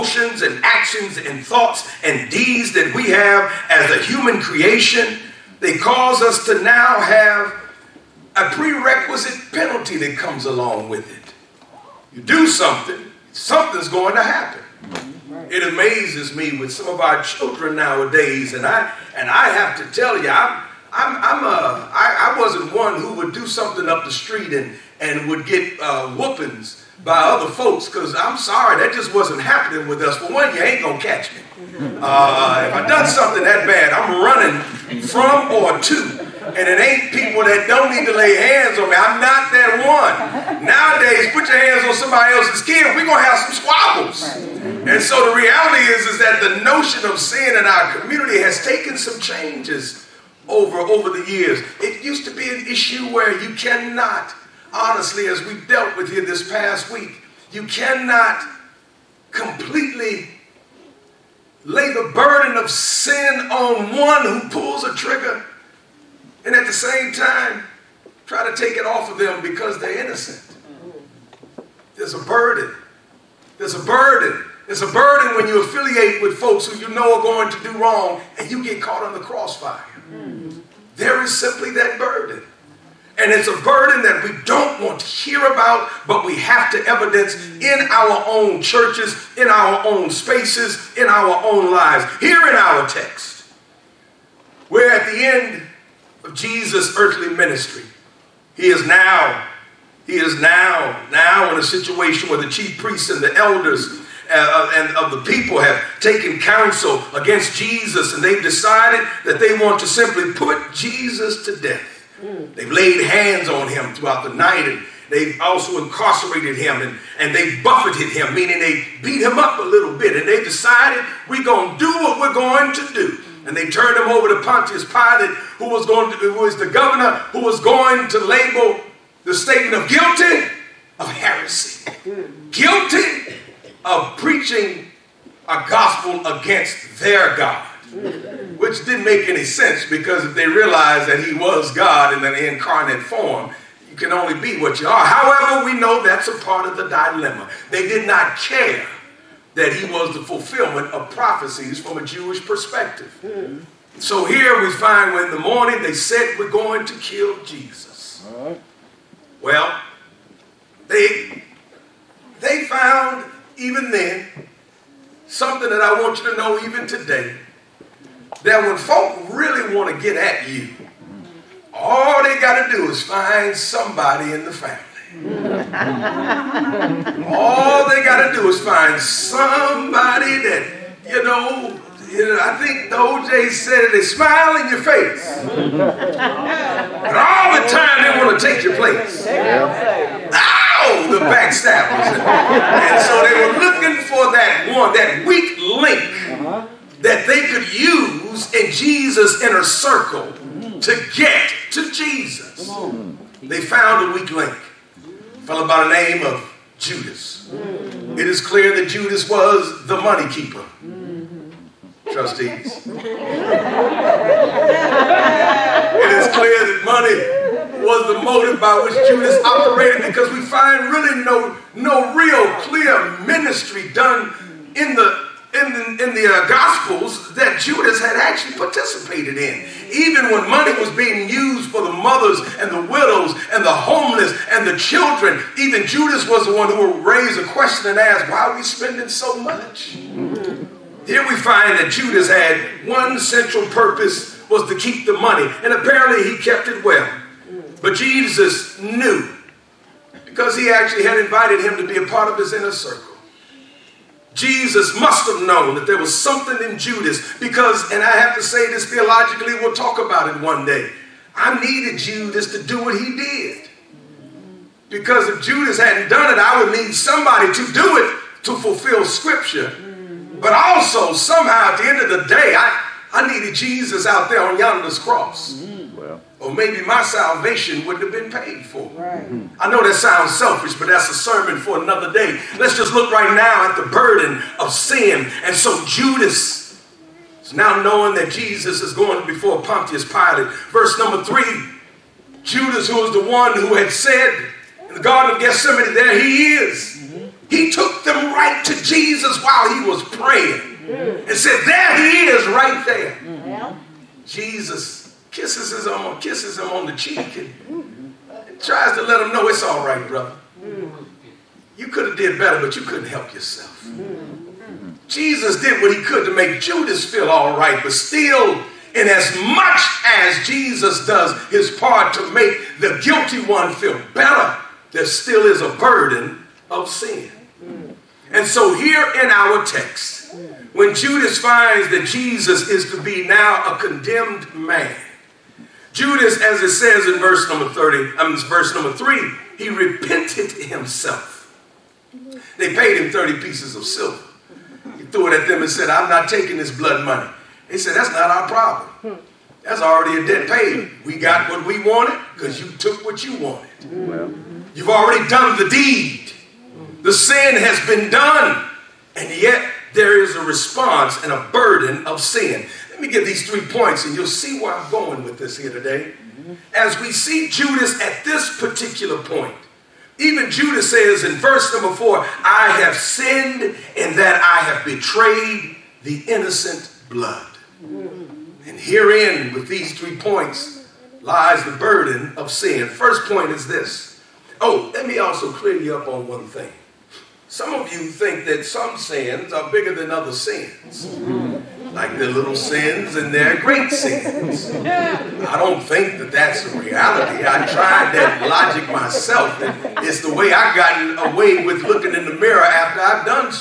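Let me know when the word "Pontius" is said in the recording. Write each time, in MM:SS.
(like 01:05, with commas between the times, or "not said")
02:04, 04:49.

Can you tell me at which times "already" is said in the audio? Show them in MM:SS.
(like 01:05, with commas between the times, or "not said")
05:49, 05:54.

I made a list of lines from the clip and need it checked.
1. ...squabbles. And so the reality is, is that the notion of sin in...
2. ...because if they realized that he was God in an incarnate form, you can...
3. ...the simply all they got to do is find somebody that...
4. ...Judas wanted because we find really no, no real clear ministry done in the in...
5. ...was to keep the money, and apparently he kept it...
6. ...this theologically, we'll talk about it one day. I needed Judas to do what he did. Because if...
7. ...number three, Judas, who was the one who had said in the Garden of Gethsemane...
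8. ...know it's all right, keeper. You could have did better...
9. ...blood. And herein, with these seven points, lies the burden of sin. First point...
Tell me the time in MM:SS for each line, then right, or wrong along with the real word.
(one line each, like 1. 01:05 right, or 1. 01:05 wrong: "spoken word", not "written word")
1. 00:43 right
2. 02:19 right
3. 02:54 wrong: "family", not "simply"
4. 03:39 wrong: "operated", not "wanted"
5. 04:04 right
6. 04:18 right
7. 04:50 right
8. 05:09 wrong: "brother", not "keeper"
9. 06:17 wrong: "three", not "seven".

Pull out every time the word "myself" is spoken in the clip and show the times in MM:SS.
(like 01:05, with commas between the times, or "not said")
06:38.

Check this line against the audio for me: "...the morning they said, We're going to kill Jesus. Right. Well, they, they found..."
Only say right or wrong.
right.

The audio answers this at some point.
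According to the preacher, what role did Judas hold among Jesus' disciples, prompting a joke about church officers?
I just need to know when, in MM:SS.
03:29.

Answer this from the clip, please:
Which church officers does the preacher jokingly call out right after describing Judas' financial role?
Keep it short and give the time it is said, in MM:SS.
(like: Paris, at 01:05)
Trustees, at 03:32.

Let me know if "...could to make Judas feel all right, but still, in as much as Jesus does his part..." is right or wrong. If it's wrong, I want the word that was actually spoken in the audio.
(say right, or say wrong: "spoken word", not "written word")
right.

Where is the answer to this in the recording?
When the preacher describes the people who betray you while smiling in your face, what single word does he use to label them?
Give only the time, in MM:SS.
03:11.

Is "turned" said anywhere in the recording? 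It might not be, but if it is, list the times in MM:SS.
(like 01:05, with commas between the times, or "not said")
02:03.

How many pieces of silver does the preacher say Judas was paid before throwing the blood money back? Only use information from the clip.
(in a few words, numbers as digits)
30.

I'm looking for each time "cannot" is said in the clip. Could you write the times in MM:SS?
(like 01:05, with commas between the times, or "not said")
00:53, 00:57.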